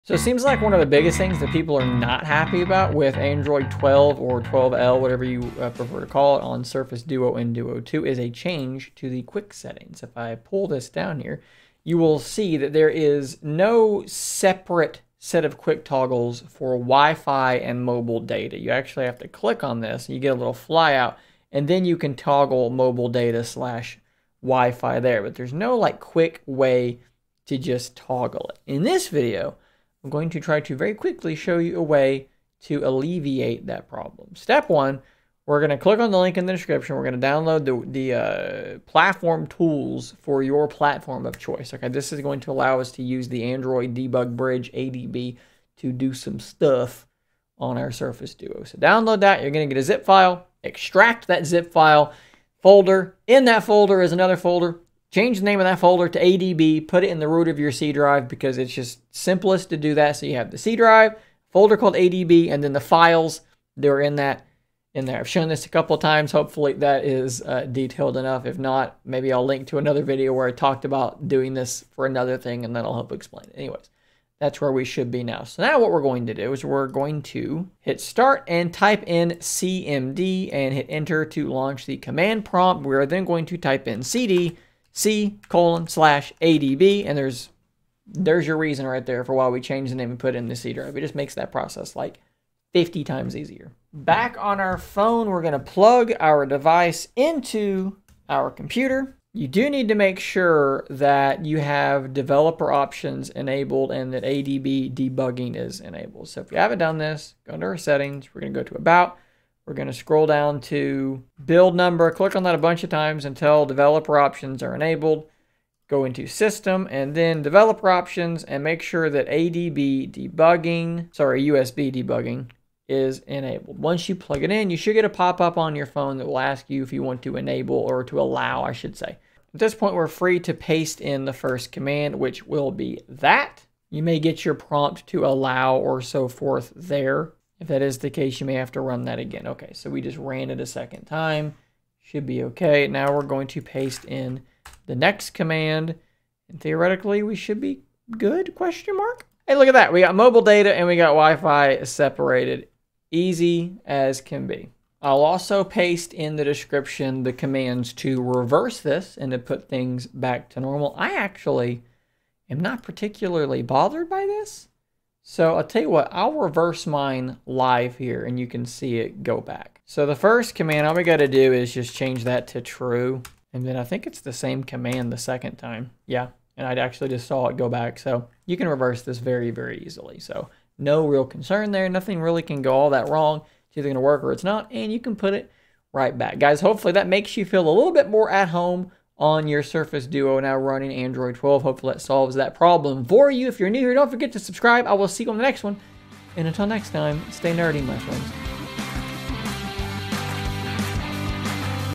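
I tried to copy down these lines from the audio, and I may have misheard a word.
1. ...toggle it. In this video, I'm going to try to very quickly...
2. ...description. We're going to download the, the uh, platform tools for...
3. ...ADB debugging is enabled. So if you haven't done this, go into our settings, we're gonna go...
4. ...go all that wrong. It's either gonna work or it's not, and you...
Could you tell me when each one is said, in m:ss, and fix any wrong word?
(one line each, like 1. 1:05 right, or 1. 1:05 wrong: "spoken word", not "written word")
1. 0:27 right
2. 0:36 right
3. 1:44 right
4. 3:02 right.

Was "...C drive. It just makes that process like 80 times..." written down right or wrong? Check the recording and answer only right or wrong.
wrong.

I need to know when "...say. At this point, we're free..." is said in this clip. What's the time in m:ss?
2:08.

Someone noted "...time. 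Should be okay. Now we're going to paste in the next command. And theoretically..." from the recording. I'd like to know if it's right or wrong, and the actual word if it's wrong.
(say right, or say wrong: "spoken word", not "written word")
right.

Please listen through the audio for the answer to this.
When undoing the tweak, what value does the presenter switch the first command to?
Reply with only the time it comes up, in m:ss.
2:52.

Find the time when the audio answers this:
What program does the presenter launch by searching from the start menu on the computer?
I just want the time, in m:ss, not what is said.
1:19.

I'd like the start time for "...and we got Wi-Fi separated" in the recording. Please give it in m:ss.
2:30.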